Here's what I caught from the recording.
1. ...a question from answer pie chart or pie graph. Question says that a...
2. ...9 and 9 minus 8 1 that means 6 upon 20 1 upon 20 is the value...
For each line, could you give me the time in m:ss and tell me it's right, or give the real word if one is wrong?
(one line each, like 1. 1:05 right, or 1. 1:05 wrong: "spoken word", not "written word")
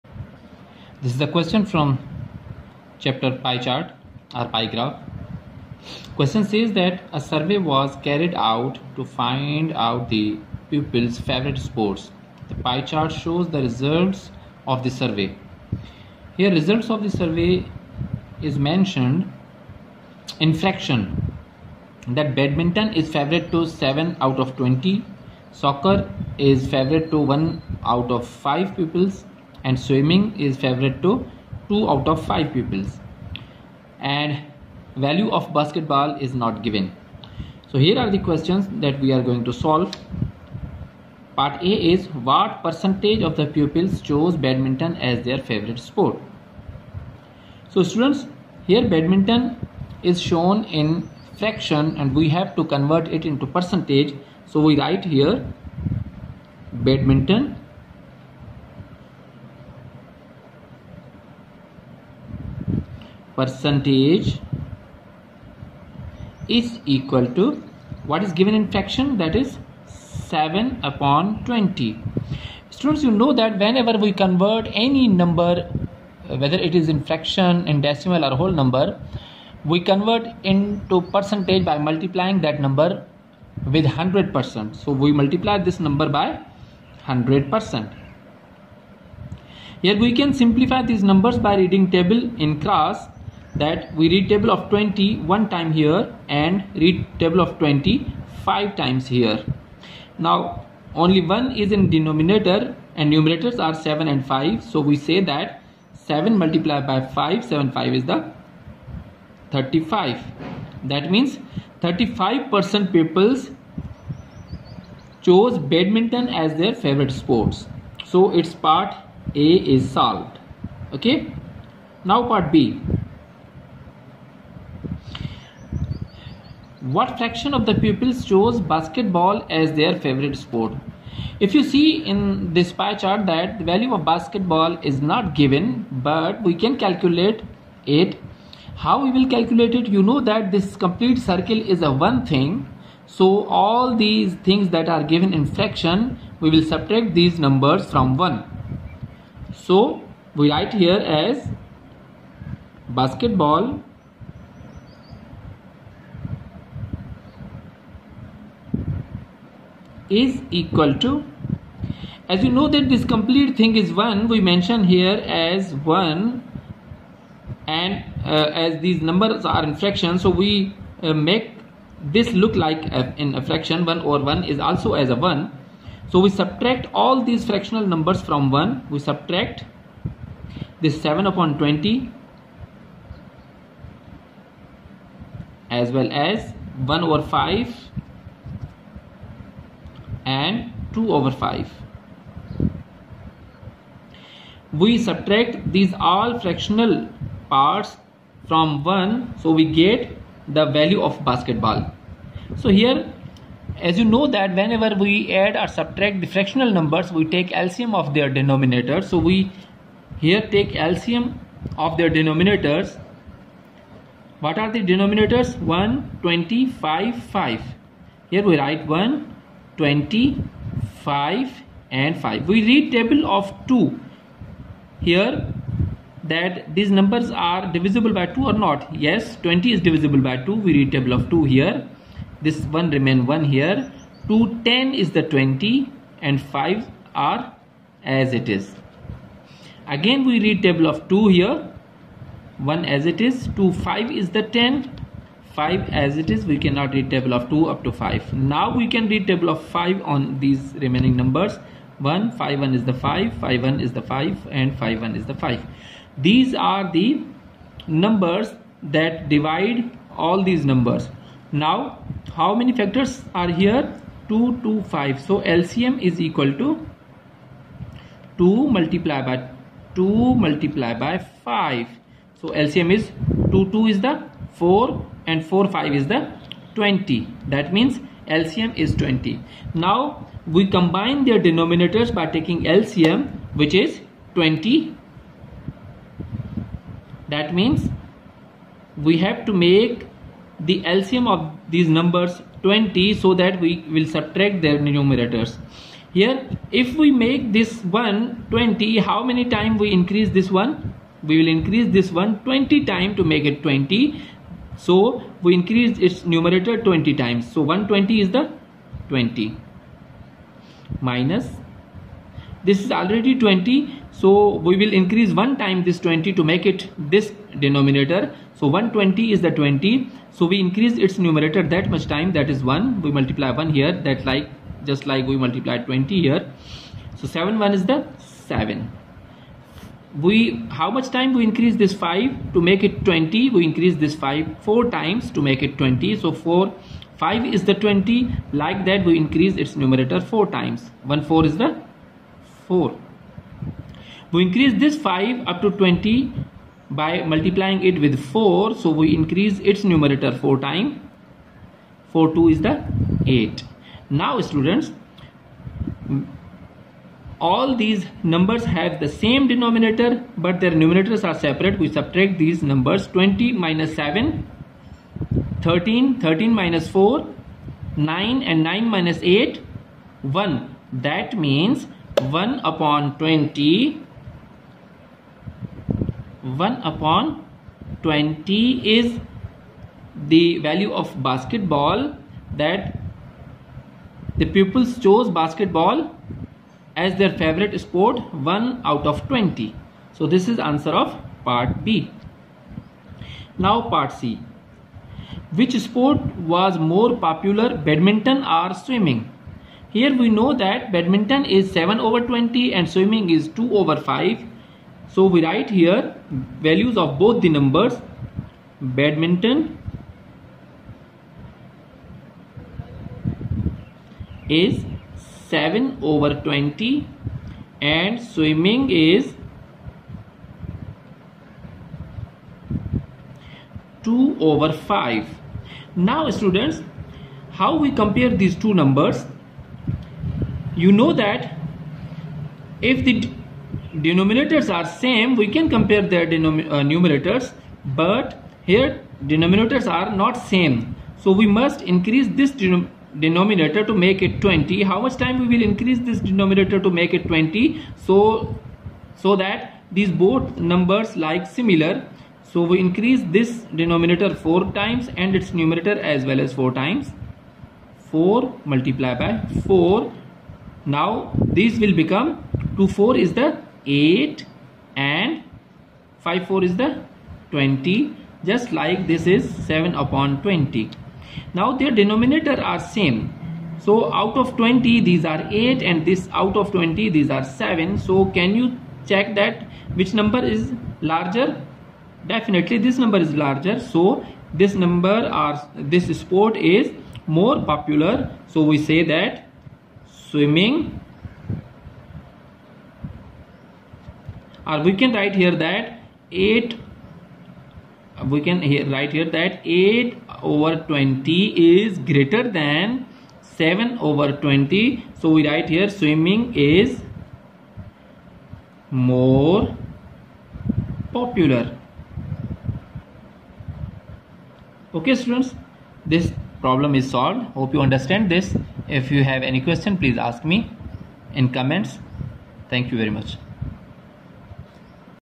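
1. 0:01 wrong: "chapter", not "answer"
2. 6:08 wrong: "1", not "6".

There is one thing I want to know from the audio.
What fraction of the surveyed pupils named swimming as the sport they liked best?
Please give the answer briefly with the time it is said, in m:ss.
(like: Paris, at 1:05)
2/5, at 0:31.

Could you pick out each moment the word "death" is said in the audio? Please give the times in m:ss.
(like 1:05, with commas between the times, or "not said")
not said.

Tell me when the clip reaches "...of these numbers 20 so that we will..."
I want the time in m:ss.
4:51.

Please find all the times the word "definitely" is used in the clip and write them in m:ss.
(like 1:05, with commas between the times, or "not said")
8:02.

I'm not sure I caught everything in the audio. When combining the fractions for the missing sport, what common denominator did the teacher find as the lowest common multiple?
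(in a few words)
20.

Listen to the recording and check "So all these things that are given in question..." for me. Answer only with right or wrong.
wrong.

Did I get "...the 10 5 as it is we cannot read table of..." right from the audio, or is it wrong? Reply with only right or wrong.
right.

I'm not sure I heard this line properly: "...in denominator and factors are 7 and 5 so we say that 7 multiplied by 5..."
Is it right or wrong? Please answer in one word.
wrong.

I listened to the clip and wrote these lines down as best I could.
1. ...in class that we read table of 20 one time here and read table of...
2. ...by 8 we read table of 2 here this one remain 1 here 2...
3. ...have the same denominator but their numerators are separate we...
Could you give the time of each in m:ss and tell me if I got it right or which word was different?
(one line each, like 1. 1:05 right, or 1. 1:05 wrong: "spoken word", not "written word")
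1. 1:32 right
2. 3:50 wrong: "2", not "8"
3. 5:58 right.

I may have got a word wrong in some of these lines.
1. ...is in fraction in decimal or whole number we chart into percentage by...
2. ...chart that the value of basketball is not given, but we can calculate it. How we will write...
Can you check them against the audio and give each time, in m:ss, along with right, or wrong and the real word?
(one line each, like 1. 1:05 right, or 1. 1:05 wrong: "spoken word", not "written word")
1. 1:16 wrong: "convert", not "chart"
2. 2:12 wrong: "calculate", not "write".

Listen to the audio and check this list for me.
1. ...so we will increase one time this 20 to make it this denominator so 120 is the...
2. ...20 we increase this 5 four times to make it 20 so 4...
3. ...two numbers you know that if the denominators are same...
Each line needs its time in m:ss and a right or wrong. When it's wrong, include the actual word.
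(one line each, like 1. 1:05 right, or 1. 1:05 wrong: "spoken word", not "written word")
1. 5:14 right
2. 5:33 right
3. 7:08 right.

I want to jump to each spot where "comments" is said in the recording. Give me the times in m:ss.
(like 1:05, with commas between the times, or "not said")
8:41.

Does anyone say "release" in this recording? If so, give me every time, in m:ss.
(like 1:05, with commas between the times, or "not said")
not said.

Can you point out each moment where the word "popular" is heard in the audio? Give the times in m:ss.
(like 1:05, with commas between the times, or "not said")
6:37, 8:07, 8:31.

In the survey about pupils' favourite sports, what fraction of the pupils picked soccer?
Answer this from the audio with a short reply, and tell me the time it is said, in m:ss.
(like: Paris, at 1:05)
1/5, at 0:27.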